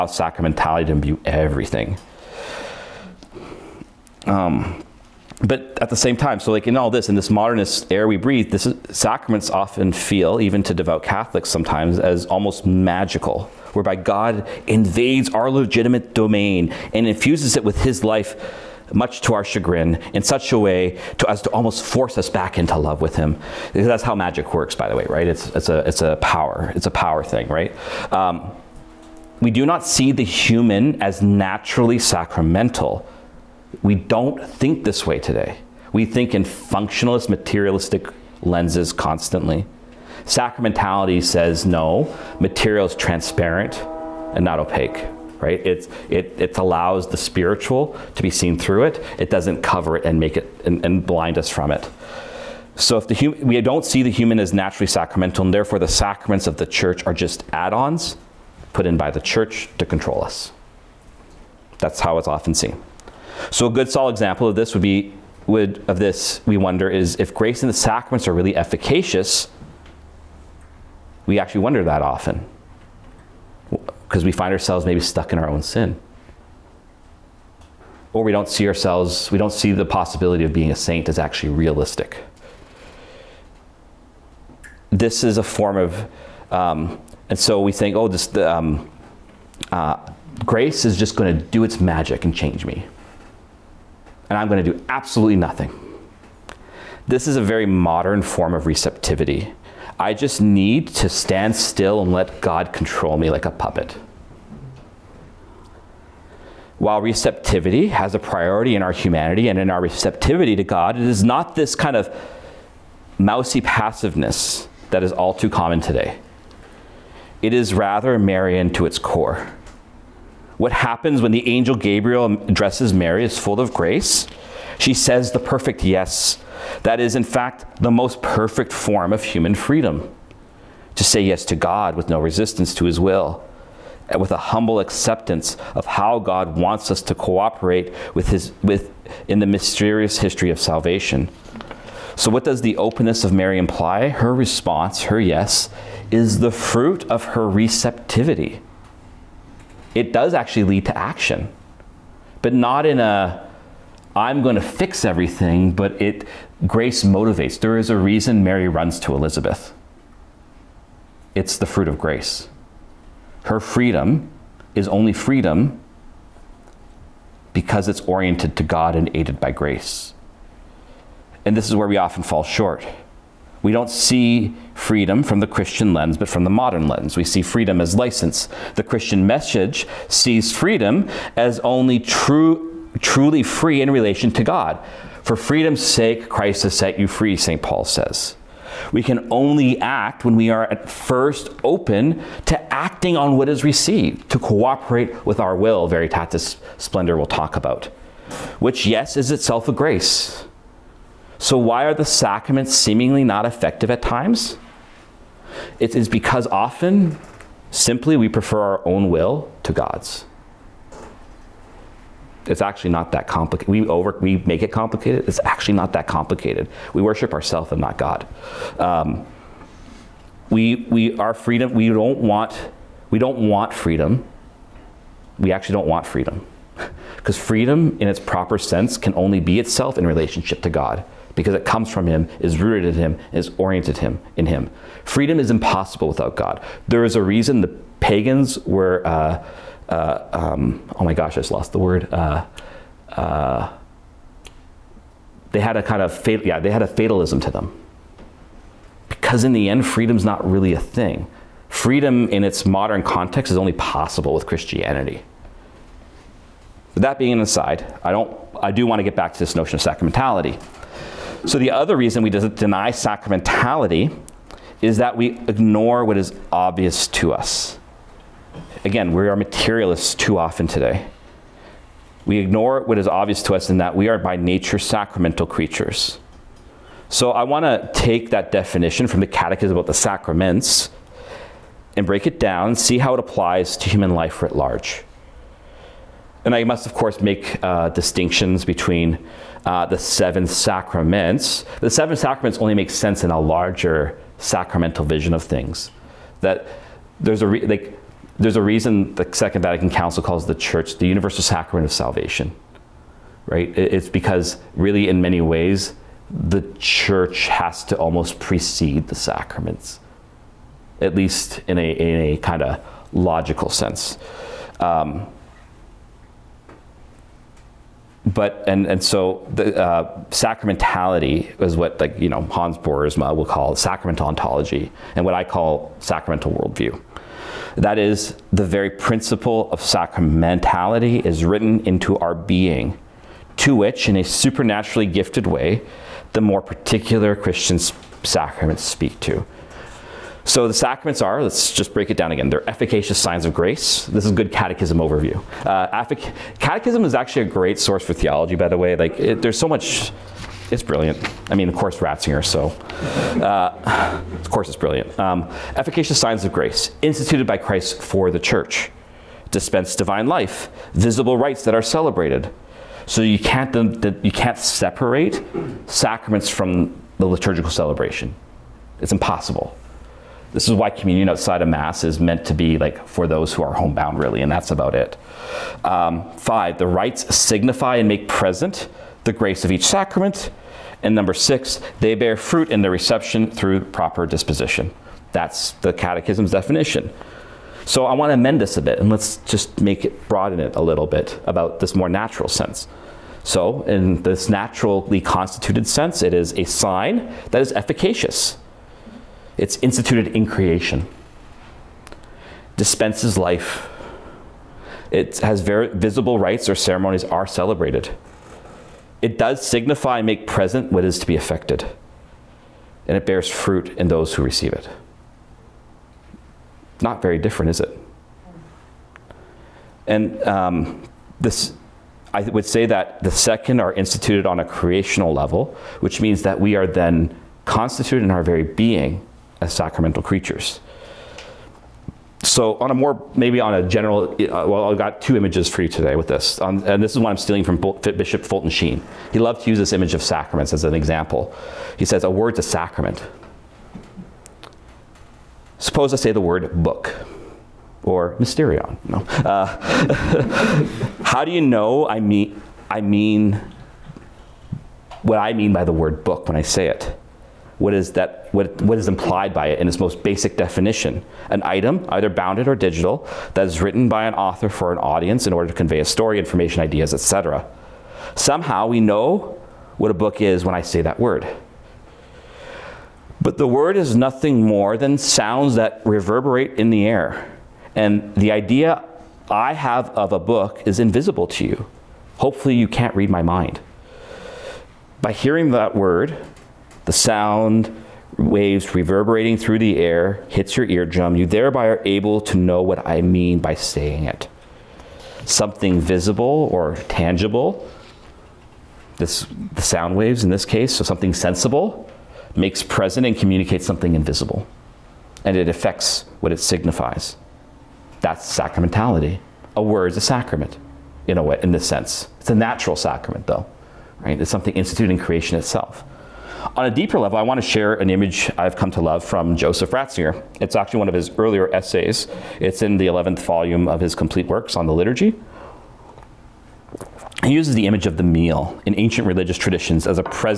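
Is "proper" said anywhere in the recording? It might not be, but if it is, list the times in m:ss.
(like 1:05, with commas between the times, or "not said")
3:48, 6:23.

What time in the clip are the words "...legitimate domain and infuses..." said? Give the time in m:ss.
0:15.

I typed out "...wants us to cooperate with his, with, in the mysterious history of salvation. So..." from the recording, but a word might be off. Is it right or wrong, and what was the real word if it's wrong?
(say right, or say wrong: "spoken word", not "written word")
right.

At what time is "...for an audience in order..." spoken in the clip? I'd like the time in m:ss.
7:44.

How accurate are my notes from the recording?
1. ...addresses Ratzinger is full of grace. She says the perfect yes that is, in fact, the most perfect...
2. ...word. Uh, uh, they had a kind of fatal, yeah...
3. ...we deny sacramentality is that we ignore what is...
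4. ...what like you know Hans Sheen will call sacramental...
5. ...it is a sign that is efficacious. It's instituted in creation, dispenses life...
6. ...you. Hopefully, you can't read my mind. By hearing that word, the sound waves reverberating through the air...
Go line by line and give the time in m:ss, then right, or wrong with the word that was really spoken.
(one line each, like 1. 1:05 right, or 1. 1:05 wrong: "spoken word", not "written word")
1. 2:02 wrong: "Mary", not "Ratzinger"
2. 4:01 right
3. 4:22 right
4. 5:21 wrong: "Boersma", not "Sheen"
5. 6:36 right
6. 8:01 right.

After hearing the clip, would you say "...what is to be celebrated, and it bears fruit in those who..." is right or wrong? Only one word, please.
wrong.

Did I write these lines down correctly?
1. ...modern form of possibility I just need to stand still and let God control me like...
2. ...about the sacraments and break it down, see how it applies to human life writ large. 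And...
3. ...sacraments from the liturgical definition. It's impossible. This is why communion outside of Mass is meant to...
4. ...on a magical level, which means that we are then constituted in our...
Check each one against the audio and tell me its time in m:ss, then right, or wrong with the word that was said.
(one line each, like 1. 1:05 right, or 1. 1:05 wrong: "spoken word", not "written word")
1. 1:37 wrong: "receptivity", not "possibility"
2. 4:39 right
3. 6:05 wrong: "celebration", not "definition"
4. 7:04 wrong: "creational", not "magical".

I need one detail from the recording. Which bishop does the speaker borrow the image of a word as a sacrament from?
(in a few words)
Fulton Sheen.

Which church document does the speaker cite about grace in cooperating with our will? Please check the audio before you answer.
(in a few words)
Veritatis Splendor.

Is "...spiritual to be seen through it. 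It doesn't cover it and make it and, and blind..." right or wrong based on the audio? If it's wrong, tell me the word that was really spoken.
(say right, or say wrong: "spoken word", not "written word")
right.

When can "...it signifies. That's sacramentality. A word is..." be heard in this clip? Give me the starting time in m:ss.
8:26.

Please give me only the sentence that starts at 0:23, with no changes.
That's how magic works, by the way, right?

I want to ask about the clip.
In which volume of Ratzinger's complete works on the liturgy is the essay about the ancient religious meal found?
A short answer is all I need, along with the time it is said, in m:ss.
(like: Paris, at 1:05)
11th, at 8:43.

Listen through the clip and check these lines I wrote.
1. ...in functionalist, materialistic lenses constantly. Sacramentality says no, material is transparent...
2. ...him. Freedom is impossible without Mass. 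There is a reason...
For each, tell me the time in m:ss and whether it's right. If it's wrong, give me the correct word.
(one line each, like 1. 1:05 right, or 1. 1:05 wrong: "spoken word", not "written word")
1. 0:36 right
2. 3:54 wrong: "God", not "Mass".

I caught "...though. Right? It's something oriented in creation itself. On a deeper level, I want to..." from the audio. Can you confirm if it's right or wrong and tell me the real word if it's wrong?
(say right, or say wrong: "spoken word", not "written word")
wrong: "instituted", not "oriented".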